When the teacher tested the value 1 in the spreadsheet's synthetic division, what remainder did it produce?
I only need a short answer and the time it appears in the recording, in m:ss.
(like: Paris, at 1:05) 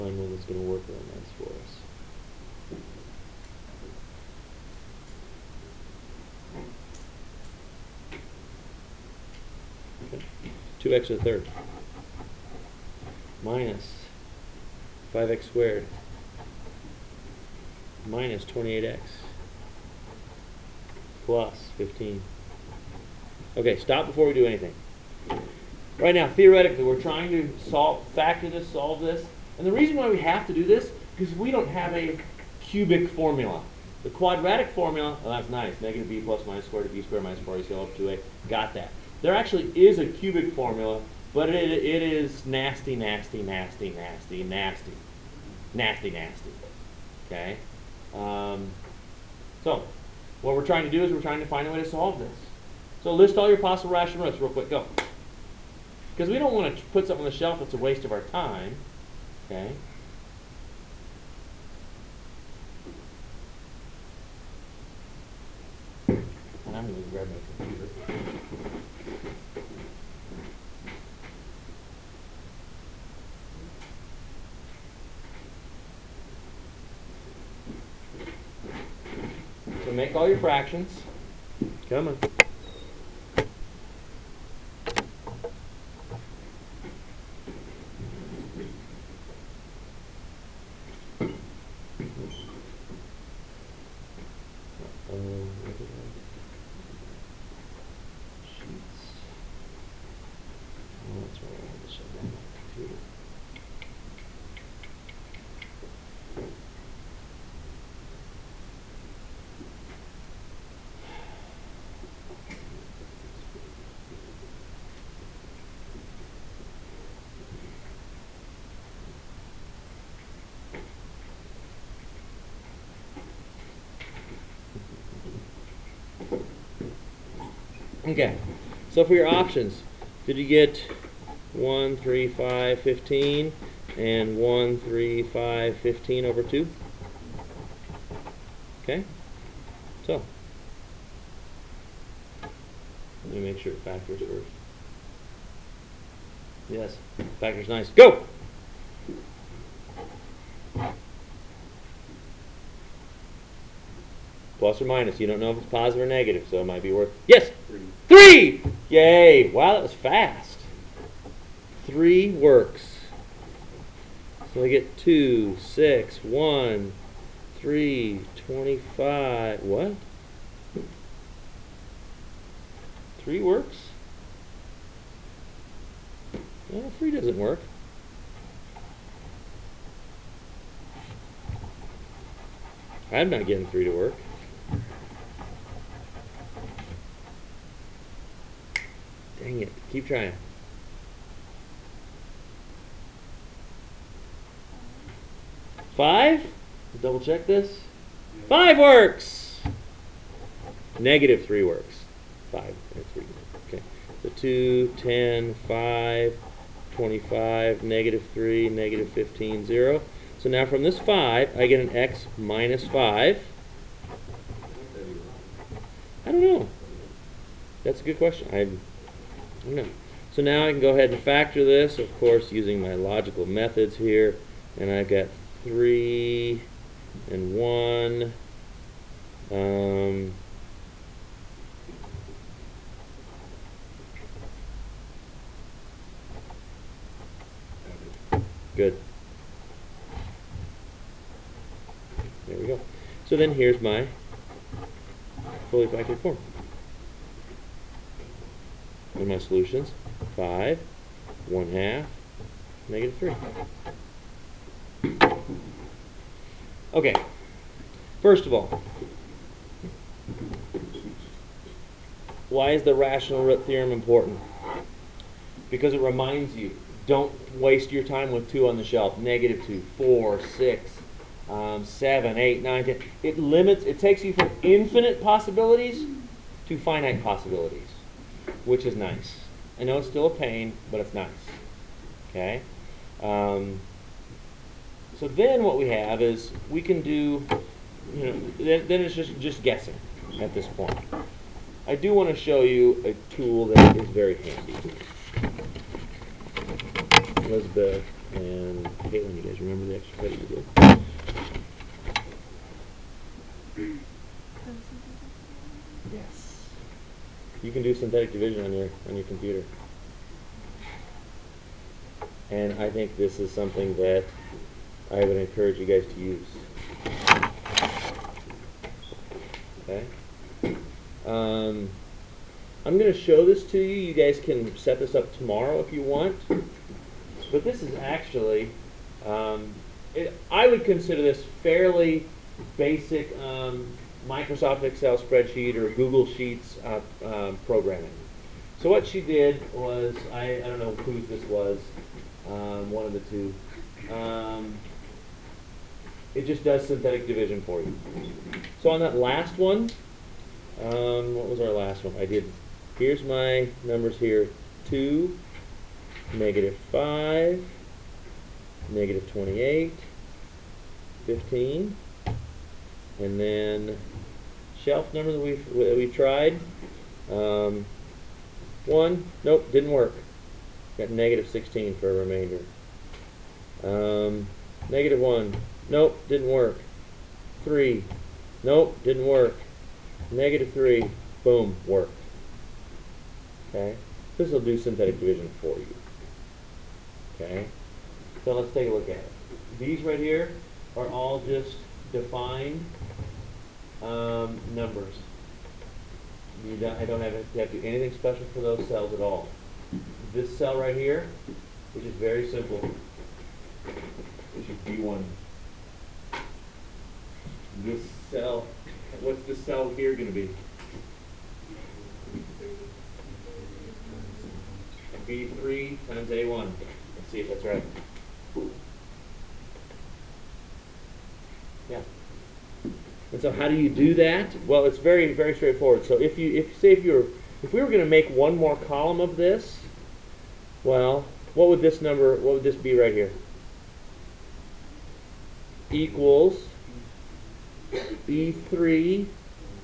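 -16, at 6:11.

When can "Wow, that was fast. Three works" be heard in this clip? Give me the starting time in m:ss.
2:39.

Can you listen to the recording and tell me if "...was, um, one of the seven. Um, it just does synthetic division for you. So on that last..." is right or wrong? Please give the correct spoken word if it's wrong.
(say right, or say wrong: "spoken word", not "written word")
wrong: "two", not "seven".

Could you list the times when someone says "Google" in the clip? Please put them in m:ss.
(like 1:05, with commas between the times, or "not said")
5:35.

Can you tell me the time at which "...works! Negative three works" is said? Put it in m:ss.
3:18.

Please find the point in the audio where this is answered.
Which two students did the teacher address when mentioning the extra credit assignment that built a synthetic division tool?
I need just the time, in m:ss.
4:57.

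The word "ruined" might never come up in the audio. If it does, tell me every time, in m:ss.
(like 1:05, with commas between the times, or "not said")
not said.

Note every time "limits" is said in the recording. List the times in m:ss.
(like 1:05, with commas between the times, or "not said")
4:33.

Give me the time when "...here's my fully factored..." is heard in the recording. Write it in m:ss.
4:03.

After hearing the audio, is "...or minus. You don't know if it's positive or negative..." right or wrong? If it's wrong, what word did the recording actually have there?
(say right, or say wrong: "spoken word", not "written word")
right.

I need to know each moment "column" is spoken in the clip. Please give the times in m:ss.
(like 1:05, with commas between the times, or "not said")
7:08.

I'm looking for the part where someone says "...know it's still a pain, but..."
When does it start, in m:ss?
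4:39.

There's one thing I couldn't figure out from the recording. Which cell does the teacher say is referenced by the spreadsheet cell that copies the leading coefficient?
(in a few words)
B1.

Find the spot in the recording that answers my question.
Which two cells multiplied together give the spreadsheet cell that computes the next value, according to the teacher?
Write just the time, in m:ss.
6:55.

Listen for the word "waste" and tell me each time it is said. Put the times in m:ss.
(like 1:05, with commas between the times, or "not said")
0:57, 4:27.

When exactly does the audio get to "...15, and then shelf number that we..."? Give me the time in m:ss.
6:01.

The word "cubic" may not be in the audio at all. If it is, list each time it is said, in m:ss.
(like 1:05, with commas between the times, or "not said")
0:32, 0:40.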